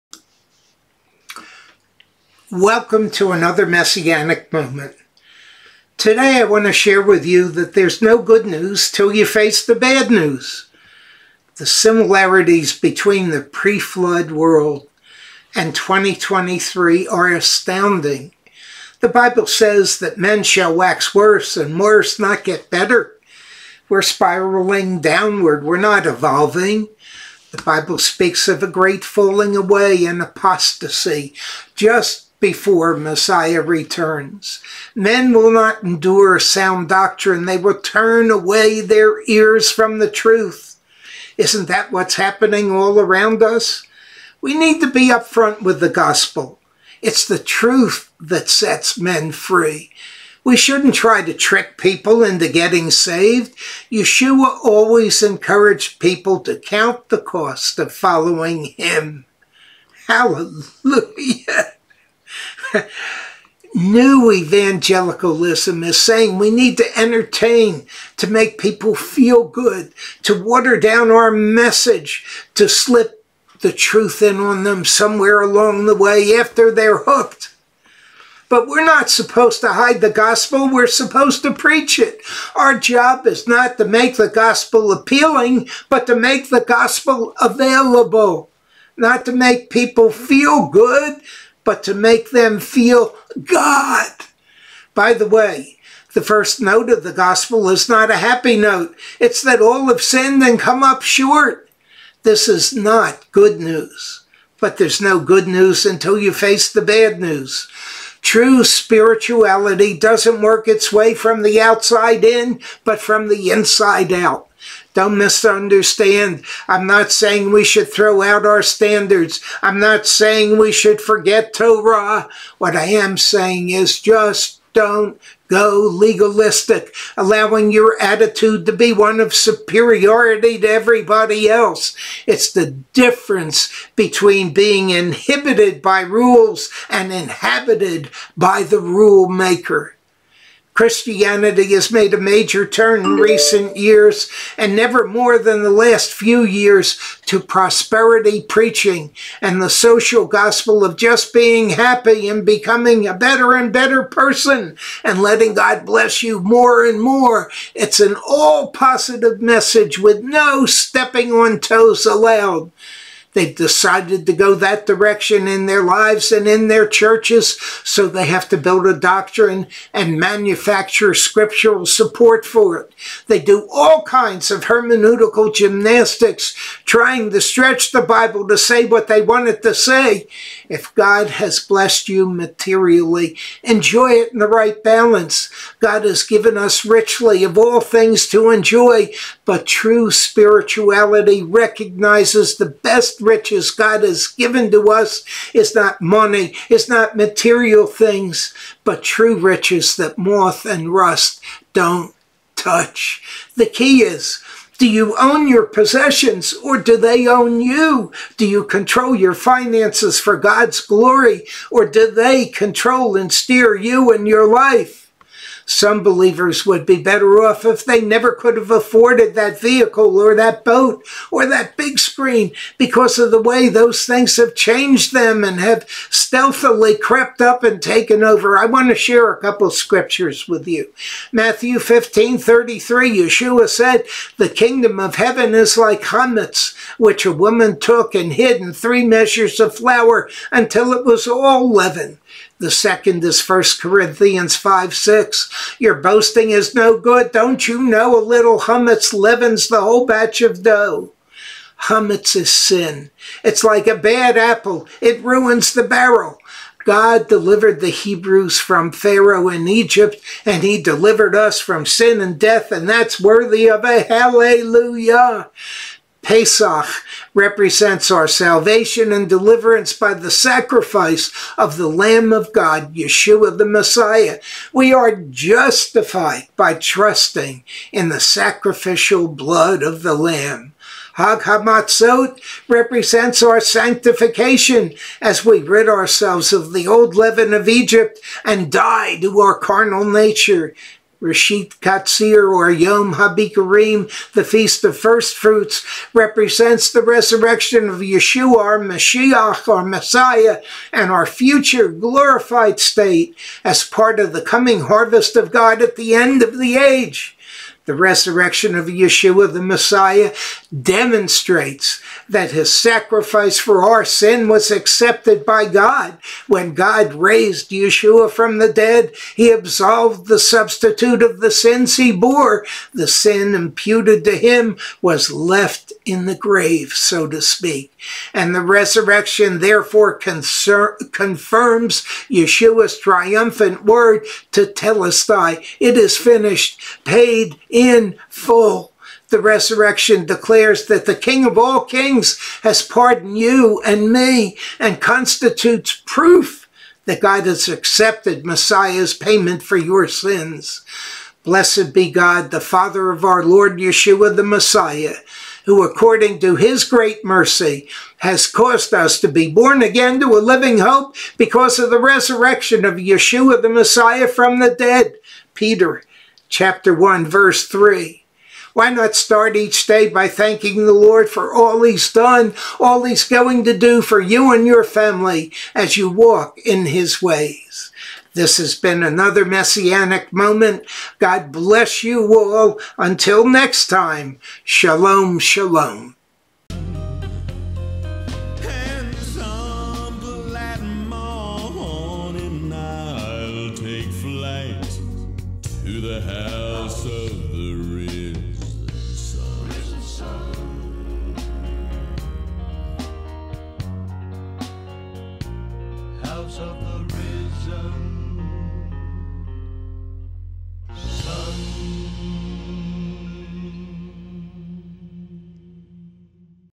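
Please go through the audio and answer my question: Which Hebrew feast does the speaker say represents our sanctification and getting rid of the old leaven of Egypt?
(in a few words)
Hag HaMatzot.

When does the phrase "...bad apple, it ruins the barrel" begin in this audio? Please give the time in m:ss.
4:13.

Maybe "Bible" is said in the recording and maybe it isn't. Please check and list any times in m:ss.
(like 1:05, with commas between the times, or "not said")
0:19, 0:27, 2:58.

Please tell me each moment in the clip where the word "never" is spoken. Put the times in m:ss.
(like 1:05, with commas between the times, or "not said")
2:24, 3:38.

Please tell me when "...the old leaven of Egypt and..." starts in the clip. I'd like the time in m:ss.
4:46.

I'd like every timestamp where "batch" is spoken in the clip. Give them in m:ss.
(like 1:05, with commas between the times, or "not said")
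4:10.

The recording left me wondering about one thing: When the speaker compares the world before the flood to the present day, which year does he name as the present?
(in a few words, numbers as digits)
2023.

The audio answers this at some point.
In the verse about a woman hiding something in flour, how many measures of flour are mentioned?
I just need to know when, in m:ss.
3:58.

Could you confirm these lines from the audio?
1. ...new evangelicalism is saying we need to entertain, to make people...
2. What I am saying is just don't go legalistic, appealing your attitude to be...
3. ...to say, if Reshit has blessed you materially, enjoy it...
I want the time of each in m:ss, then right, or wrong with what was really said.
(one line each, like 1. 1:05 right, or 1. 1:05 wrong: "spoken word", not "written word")
1. 1:03 right
2. 2:02 wrong: "allowing", not "appealing"
3. 2:59 wrong: "God", not "Reshit".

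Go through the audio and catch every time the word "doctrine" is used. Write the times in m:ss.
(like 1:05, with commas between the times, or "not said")
0:36, 2:48.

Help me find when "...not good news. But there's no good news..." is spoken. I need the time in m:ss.
1:42.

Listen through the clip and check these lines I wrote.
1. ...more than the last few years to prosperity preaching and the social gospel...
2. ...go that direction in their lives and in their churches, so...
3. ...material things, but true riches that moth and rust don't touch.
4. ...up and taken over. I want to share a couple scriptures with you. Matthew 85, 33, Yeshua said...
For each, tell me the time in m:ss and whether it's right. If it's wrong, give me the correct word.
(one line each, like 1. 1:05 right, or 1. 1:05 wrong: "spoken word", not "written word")
1. 2:25 right
2. 2:44 right
3. 3:17 right
4. 3:47 wrong: "15", not "85".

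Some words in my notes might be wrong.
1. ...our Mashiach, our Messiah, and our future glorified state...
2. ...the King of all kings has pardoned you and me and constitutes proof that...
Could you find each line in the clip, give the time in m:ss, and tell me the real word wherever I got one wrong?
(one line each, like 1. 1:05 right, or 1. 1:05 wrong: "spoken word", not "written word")
1. 4:58 right
2. 5:41 right.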